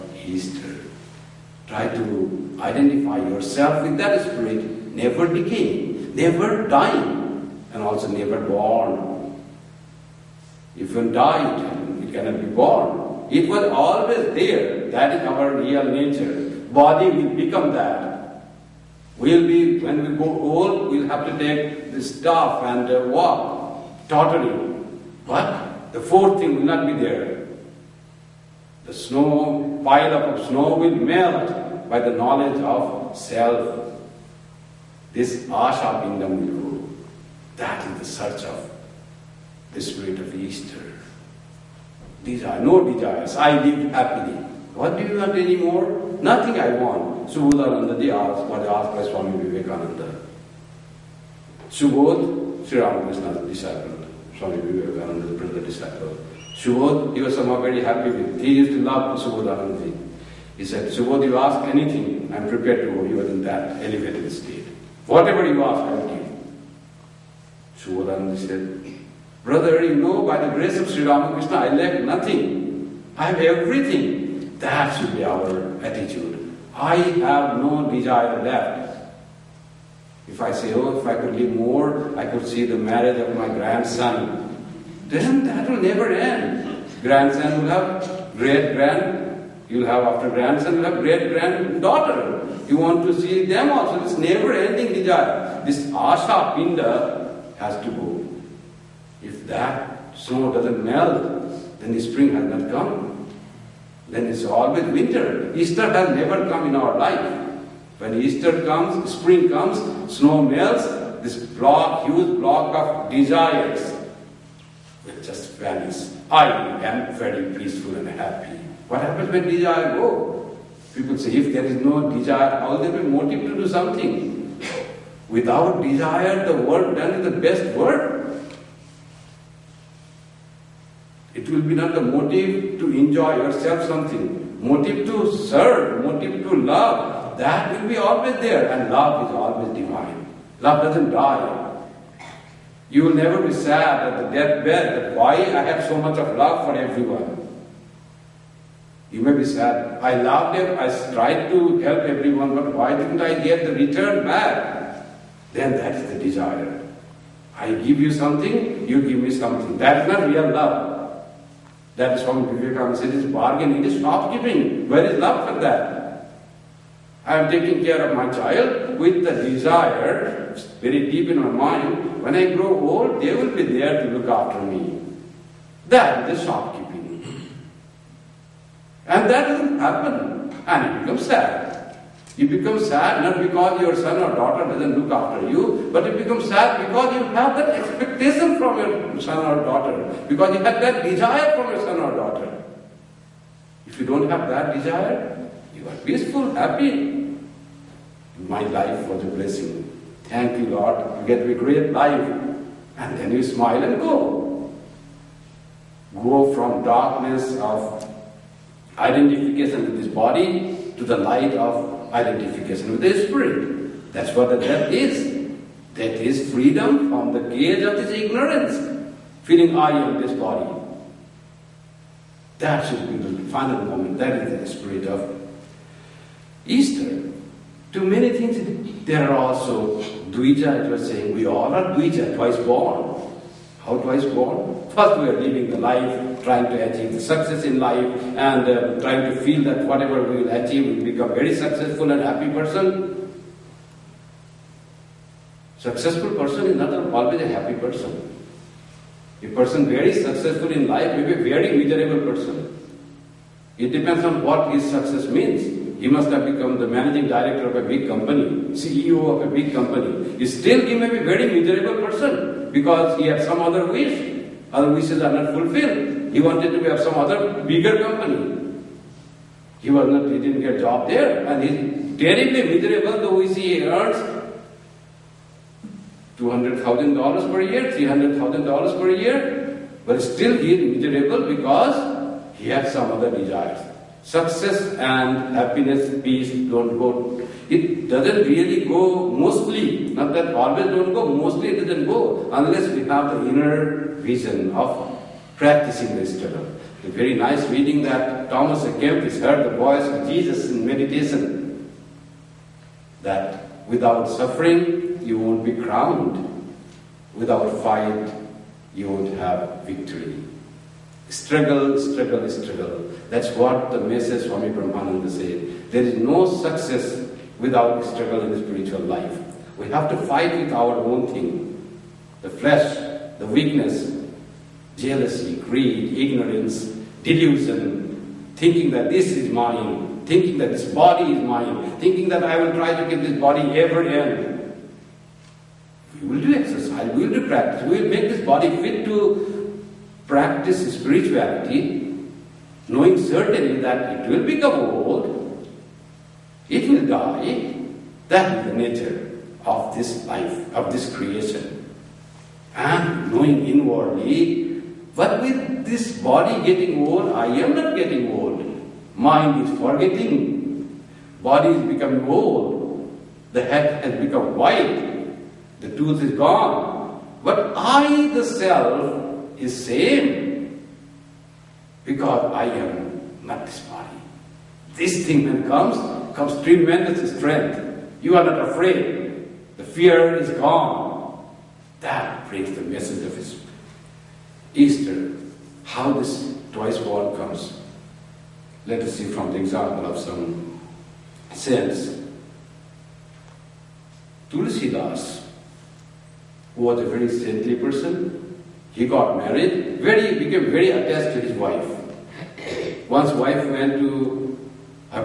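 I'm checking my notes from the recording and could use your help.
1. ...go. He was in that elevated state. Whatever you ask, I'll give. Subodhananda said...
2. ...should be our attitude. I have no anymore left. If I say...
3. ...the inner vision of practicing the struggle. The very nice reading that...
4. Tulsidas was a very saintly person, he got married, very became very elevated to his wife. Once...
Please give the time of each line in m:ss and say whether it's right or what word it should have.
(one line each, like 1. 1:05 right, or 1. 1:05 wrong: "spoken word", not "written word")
1. 1:02 right
2. 1:14 wrong: "desire", not "anymore"
3. 4:53 right
4. 6:34 wrong: "attached", not "elevated".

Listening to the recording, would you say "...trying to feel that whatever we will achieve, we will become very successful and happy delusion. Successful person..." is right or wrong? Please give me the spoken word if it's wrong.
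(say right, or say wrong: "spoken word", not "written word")
wrong: "person", not "delusion".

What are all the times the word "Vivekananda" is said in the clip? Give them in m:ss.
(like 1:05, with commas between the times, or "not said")
0:49, 0:54, 2:42.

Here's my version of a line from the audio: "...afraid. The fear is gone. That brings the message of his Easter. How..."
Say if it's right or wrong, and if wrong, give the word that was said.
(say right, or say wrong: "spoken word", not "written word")
right.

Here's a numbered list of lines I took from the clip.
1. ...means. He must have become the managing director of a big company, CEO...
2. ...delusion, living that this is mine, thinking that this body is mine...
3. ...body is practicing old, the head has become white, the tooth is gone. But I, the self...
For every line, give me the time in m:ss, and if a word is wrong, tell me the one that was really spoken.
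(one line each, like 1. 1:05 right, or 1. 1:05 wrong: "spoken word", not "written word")
1. 4:15 right
2. 5:27 wrong: "thinking", not "living"
3. 6:01 wrong: "becoming", not "practicing".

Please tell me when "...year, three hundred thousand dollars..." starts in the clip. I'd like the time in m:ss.
4:37.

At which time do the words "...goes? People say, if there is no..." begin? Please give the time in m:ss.
1:59.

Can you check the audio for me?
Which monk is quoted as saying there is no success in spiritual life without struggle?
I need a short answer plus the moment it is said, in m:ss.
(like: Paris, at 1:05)
Swami Brahmananda, at 5:14.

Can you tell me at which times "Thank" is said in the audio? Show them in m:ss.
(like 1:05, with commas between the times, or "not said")
3:20.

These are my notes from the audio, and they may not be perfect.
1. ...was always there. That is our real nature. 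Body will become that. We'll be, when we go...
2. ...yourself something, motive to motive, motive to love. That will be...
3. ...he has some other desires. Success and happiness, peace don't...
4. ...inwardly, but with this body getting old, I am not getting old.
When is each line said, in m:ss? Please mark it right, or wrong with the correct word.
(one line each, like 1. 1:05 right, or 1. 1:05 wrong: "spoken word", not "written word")
1. 0:13 right
2. 2:13 wrong: "serve", not "motive"
3. 4:42 right
4. 5:53 right.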